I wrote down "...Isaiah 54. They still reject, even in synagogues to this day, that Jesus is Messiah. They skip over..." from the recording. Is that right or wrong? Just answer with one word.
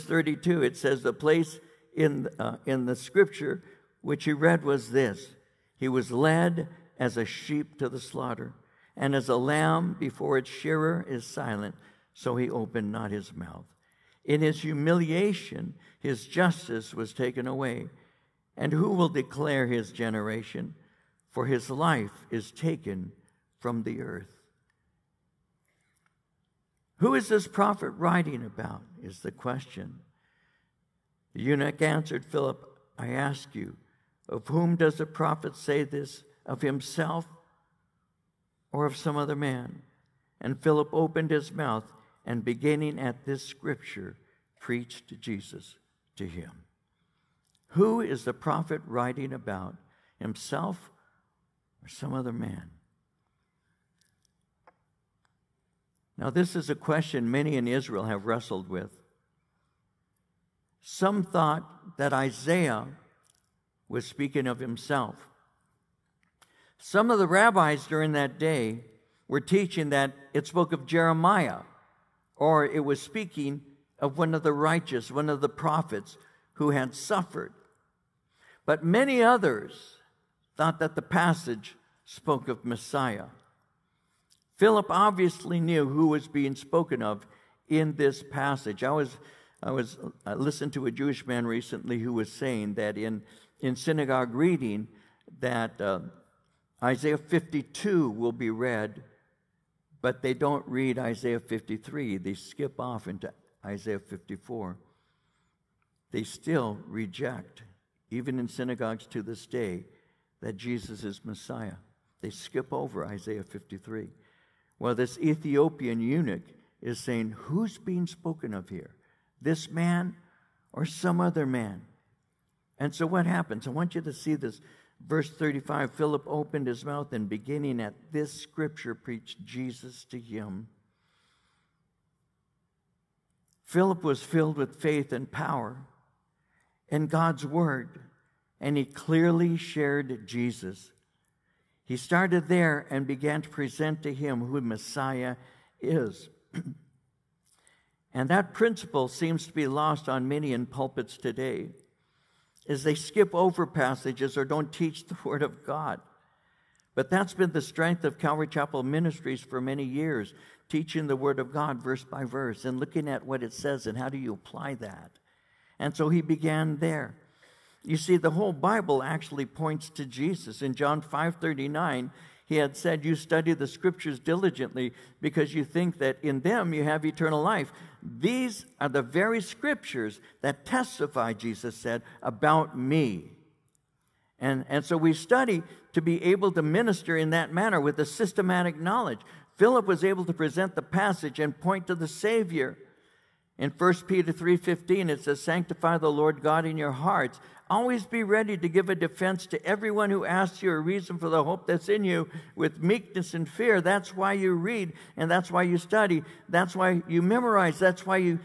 right.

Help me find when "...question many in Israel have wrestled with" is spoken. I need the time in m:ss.
0:56.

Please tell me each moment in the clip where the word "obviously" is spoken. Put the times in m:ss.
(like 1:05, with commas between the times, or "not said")
1:24.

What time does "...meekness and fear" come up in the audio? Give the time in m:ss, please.
3:22.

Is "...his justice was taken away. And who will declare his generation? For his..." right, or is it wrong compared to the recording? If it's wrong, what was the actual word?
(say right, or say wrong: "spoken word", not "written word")
right.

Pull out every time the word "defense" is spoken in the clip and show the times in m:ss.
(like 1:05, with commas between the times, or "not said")
3:18.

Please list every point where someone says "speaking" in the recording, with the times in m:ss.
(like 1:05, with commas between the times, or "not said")
1:04, 1:13.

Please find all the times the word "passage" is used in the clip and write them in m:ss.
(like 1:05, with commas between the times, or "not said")
1:21, 1:28, 2:33, 3:10.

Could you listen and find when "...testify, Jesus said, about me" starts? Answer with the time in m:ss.
3:00.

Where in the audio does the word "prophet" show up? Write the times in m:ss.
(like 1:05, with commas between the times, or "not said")
0:27, 0:35, 0:48, 1:15.